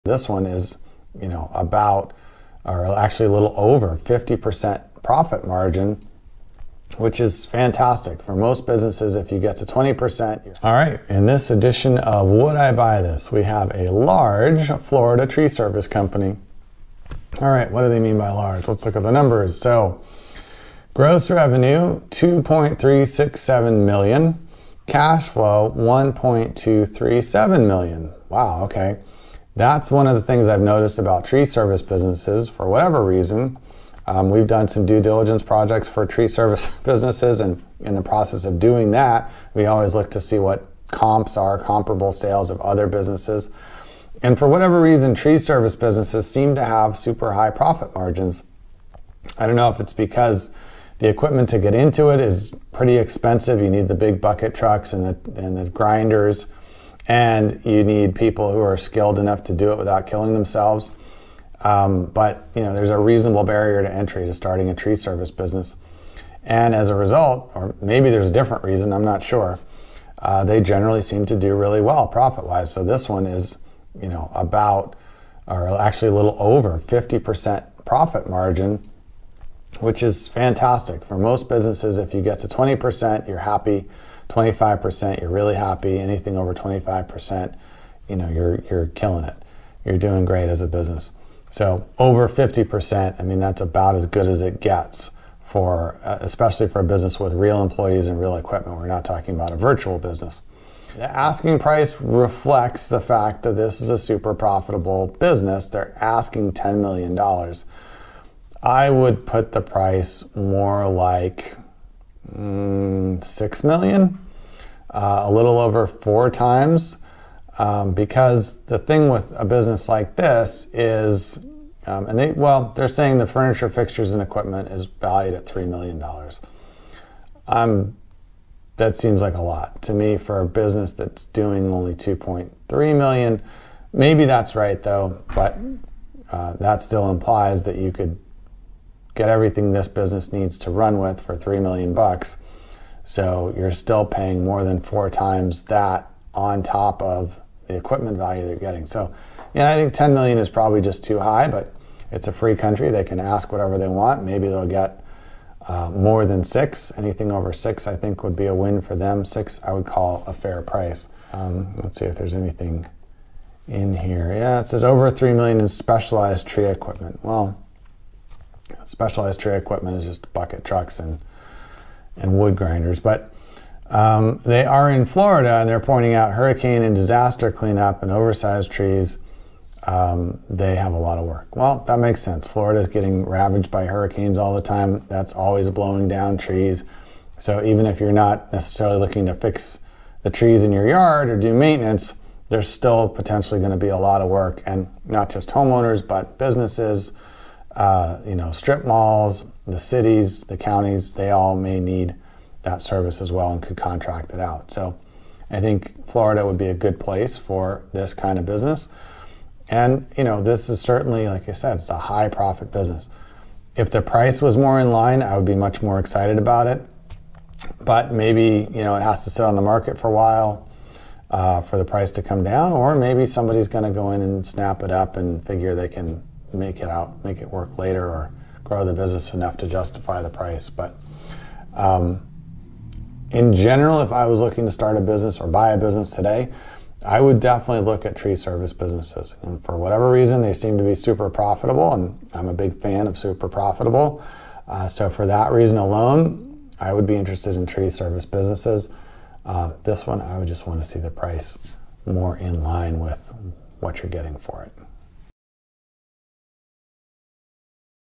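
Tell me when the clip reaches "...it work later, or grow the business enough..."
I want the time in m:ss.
3:47.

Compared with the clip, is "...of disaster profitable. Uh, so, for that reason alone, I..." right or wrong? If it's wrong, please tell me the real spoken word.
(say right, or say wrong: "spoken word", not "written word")
wrong: "super", not "disaster".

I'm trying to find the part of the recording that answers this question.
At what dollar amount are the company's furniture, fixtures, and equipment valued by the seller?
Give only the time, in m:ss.
2:05.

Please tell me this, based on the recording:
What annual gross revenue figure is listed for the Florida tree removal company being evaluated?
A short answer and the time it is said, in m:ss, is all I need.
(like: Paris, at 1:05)
$2.367 million, at 0:22.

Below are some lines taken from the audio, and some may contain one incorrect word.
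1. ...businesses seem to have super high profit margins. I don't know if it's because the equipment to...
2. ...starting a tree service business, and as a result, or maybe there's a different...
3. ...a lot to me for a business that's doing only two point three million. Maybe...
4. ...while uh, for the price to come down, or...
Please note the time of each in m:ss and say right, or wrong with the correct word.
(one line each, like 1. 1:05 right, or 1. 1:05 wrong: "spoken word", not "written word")
1. 0:45 right
2. 1:04 right
3. 2:09 right
4. 3:40 right.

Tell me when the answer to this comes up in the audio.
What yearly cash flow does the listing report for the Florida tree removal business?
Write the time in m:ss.
0:25.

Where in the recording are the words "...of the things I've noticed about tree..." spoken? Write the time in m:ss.
0:30.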